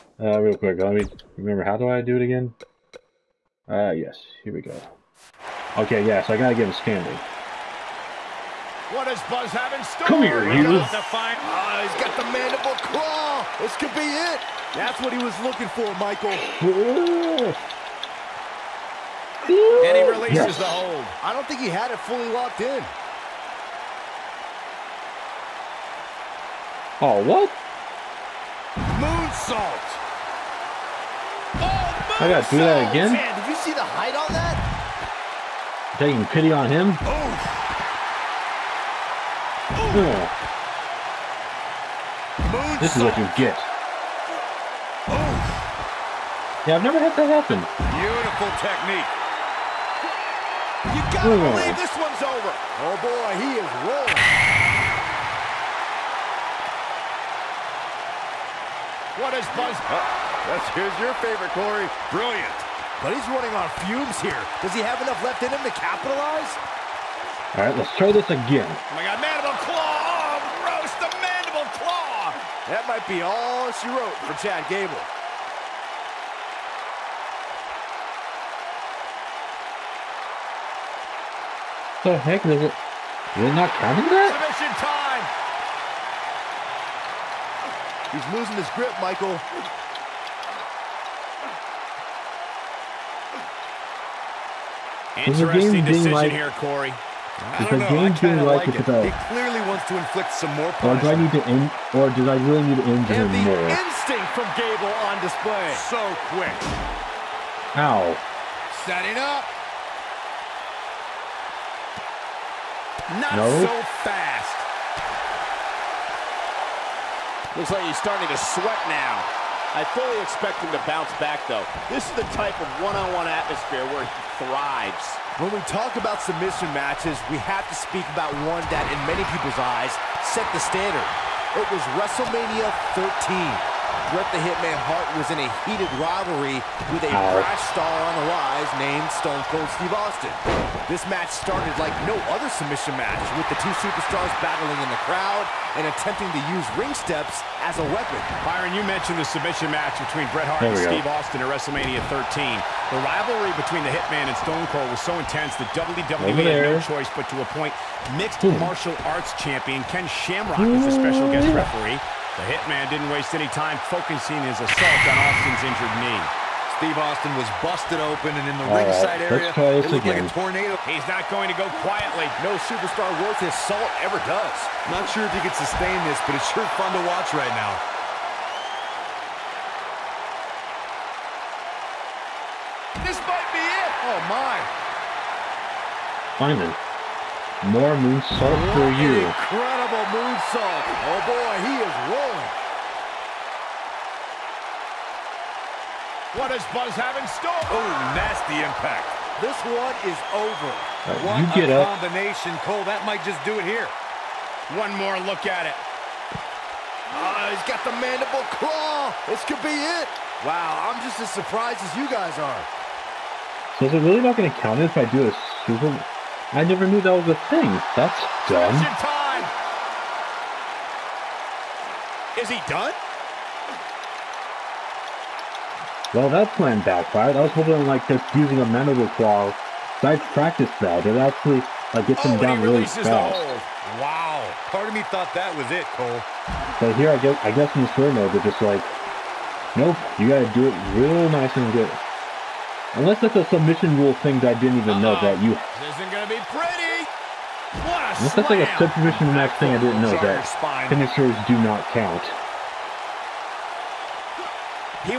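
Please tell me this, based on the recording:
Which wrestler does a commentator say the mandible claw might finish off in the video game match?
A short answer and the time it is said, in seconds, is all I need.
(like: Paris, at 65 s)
Chad Gable, at 74 s.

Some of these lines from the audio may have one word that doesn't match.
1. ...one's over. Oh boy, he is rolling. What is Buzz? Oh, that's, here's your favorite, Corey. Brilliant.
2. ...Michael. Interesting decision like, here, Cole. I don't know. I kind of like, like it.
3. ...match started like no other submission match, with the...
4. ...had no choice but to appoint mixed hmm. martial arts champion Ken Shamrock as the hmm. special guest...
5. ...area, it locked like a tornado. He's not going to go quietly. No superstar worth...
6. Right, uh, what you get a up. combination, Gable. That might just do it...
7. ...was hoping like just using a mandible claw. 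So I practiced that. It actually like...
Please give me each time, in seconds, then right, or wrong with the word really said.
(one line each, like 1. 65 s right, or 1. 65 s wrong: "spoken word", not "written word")
1. 51 s right
2. 88 s wrong: "Corey", not "Cole"
3. 141 s right
4. 156 s right
5. 169 s wrong: "looked", not "locked"
6. 201 s wrong: "Cole", not "Gable"
7. 227 s right.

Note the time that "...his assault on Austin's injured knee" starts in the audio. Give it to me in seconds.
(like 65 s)
164 s.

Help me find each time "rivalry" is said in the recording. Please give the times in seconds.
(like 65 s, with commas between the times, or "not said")
135 s, 153 s.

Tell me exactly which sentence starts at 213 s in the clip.
So is it really not going to count if I do a super...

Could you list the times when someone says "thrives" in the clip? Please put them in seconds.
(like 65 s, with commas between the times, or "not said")
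124 s.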